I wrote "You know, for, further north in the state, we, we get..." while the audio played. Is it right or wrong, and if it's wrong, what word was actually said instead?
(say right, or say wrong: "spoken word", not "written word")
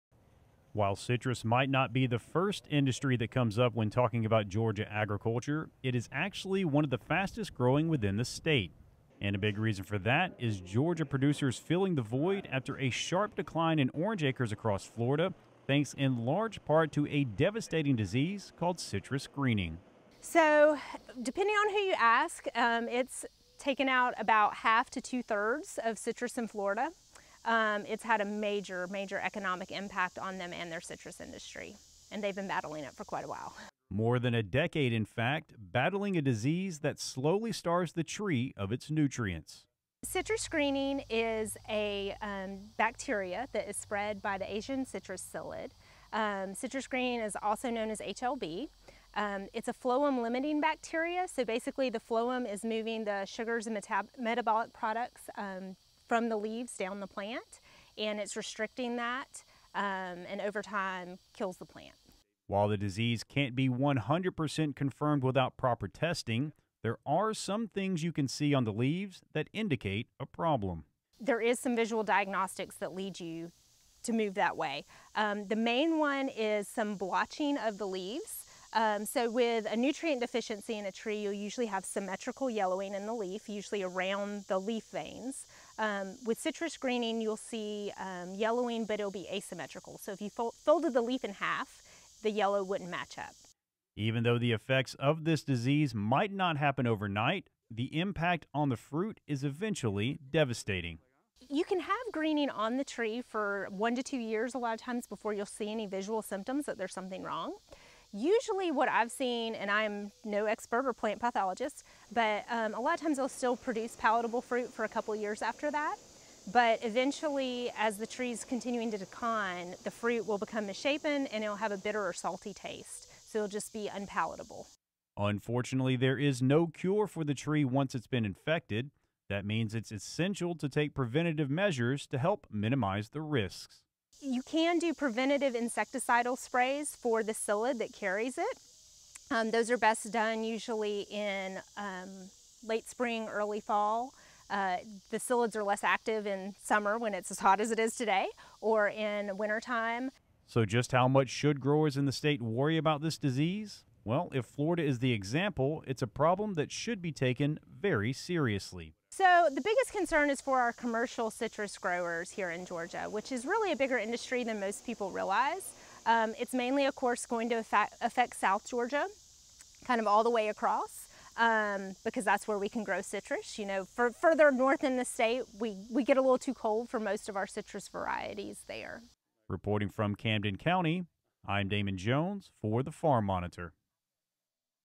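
right.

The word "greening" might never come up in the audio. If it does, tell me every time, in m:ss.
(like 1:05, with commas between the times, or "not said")
0:19, 0:40, 0:46, 1:26, 1:42.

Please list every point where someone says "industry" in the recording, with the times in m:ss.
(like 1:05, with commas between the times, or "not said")
0:02, 0:31, 2:43.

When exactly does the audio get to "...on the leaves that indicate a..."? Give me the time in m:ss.
1:08.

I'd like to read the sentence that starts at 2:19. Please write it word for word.
Um, those are best done usually in um, late spring, early fall.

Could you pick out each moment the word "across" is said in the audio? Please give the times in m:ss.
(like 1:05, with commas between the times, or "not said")
0:14, 2:50.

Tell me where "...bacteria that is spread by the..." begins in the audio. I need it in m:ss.
0:42.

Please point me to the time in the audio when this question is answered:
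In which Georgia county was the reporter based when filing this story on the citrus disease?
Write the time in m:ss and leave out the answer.
3:00.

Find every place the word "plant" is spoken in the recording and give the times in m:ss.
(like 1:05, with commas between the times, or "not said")
0:57, 1:01, 1:50.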